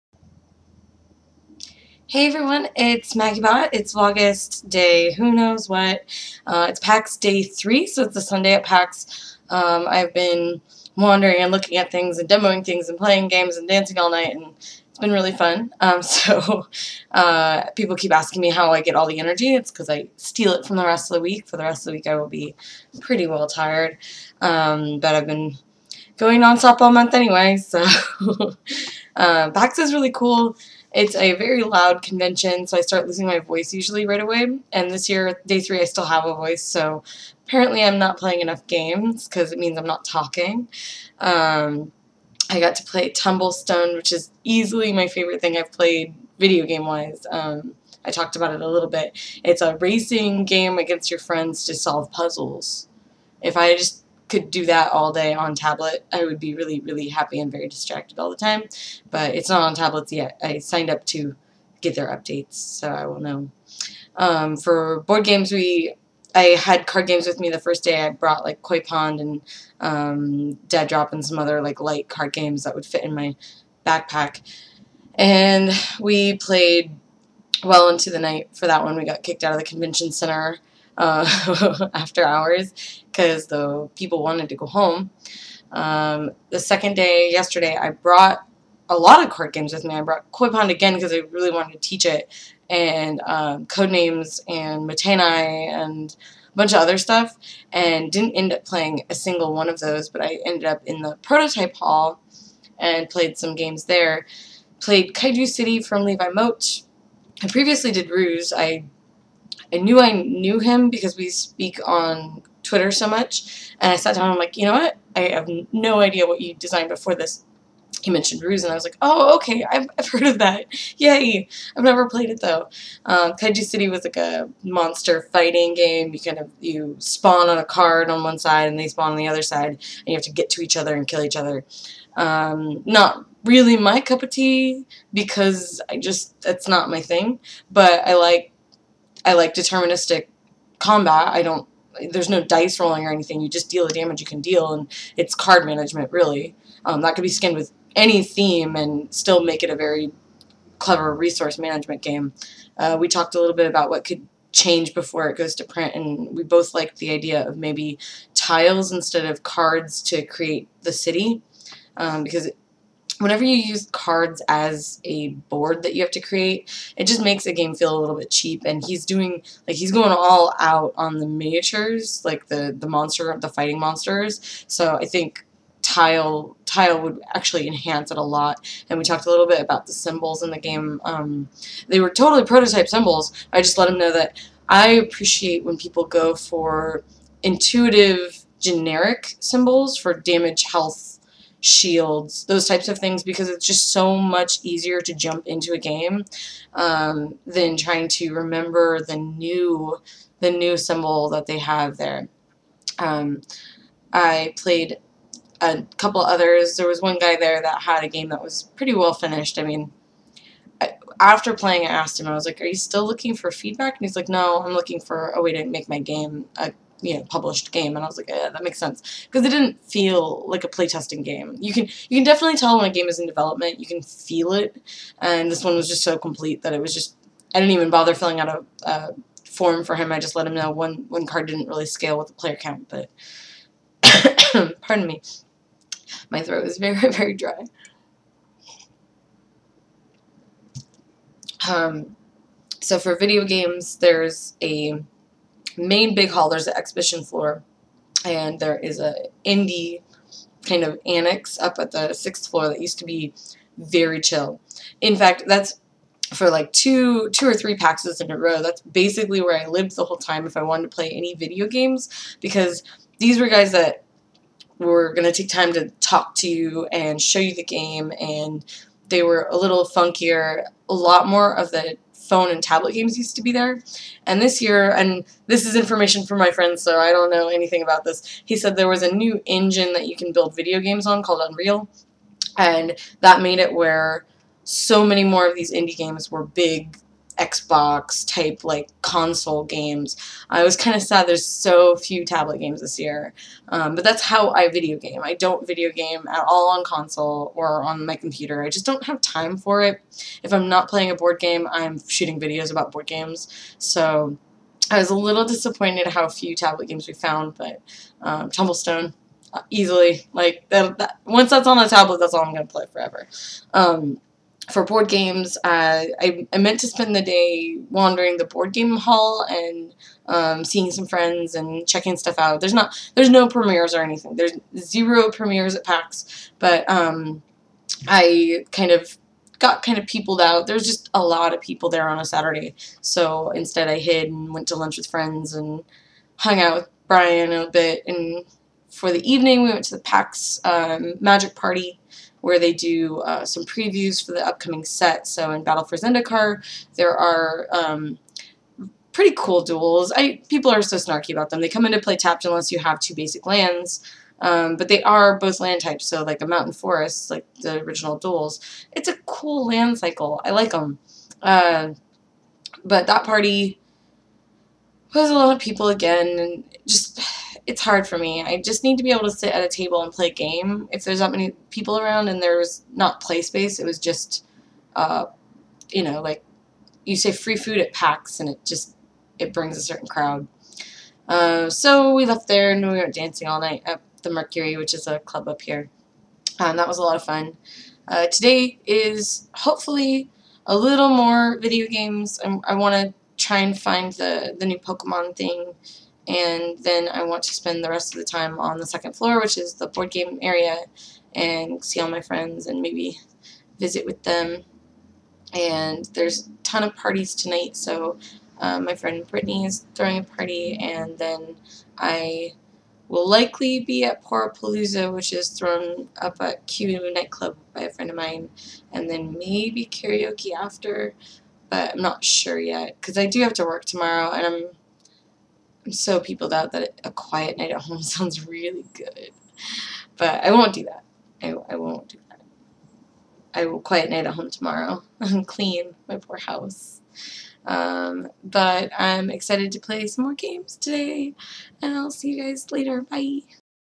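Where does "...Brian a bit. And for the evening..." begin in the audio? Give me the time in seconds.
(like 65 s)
337 s.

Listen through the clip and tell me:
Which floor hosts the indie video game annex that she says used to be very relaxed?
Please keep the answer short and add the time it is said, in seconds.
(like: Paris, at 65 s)
Sixth floor, at 252 s.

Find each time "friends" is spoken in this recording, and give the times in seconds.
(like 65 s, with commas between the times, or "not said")
51 s, 276 s, 321 s, 335 s, 402 s, 408 s, 417 s.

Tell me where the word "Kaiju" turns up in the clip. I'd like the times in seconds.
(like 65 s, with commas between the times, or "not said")
105 s, 123 s.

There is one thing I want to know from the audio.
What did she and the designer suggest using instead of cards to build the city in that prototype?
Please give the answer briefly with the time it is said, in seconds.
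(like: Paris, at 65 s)
Tiles, at 158 s.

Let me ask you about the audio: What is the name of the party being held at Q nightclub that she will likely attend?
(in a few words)
Porapalooza.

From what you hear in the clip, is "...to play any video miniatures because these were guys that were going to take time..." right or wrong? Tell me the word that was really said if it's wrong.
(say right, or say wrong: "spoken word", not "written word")
wrong: "games", not "miniatures".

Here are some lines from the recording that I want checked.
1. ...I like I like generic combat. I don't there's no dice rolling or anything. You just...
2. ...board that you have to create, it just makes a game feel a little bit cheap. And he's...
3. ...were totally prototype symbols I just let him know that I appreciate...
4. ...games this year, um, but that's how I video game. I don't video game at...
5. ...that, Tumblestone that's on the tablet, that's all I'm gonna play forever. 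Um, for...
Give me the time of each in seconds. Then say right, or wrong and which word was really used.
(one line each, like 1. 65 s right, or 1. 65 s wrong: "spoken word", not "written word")
1. 138 s wrong: "deterministic", not "generic"
2. 165 s right
3. 181 s right
4. 292 s right
5. 310 s wrong: "Once", not "Tumblestone".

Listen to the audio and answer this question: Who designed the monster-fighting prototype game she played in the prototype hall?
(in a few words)
Levi Moat.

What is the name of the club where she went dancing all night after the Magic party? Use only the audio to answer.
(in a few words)
The Mercury.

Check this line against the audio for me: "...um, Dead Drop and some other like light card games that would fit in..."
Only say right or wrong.
right.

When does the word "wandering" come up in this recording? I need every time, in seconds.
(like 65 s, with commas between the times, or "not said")
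10 s, 317 s.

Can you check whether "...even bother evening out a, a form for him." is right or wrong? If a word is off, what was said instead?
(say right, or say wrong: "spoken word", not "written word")
wrong: "filling", not "evening".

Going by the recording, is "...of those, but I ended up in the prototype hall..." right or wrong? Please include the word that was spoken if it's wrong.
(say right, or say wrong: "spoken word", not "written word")
right.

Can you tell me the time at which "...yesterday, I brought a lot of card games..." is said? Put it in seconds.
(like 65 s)
87 s.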